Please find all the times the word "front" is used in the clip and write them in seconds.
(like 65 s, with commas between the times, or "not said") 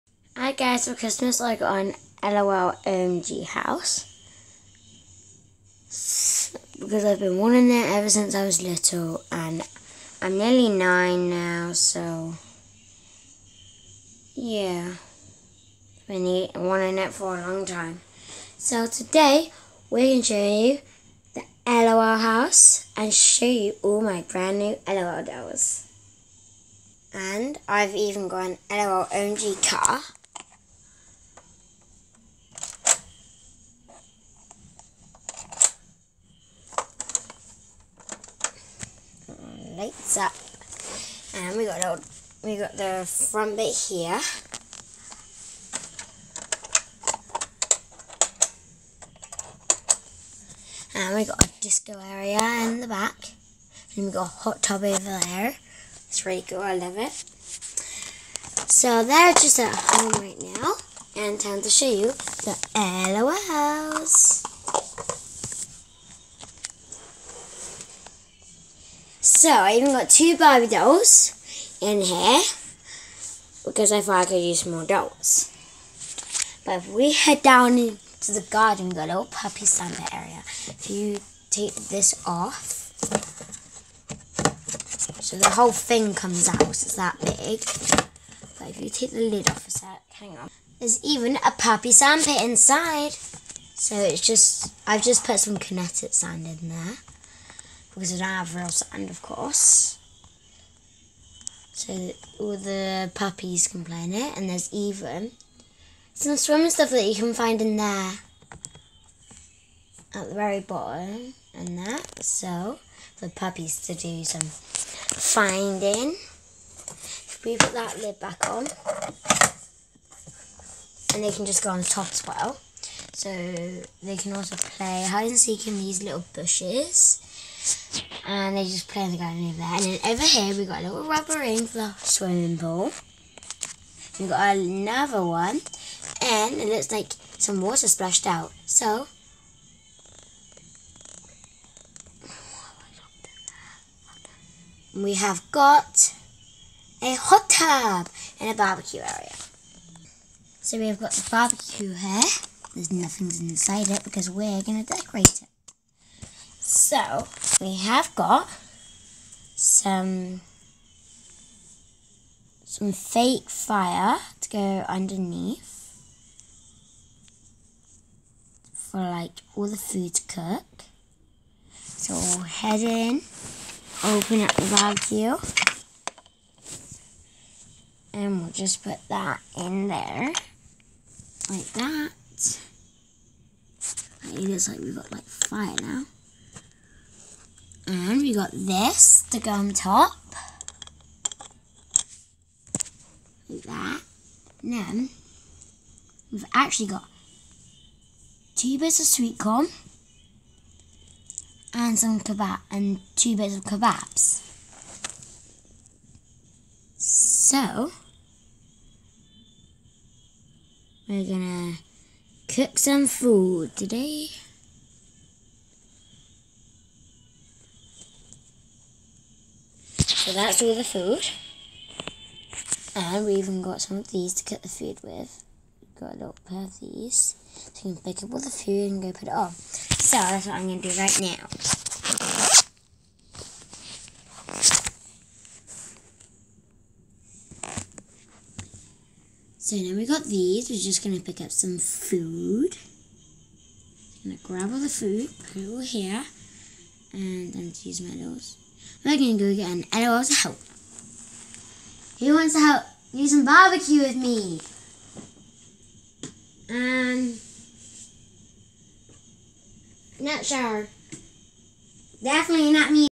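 43 s.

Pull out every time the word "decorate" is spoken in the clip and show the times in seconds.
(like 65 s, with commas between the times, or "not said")
154 s.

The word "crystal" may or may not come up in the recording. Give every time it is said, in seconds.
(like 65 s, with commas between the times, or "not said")
not said.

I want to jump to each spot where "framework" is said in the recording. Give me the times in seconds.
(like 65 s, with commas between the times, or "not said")
not said.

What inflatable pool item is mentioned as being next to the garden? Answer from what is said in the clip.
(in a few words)
rubber ring.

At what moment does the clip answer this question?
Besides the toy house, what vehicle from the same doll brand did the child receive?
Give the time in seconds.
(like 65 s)
28 s.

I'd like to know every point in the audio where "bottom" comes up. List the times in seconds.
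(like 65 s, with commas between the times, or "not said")
110 s.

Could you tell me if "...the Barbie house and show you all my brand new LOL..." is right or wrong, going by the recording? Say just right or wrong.
wrong.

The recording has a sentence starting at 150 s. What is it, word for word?
So we've got the barbecue here.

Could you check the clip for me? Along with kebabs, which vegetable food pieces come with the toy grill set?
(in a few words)
sweet corn.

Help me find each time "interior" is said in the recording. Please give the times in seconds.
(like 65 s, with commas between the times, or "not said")
not said.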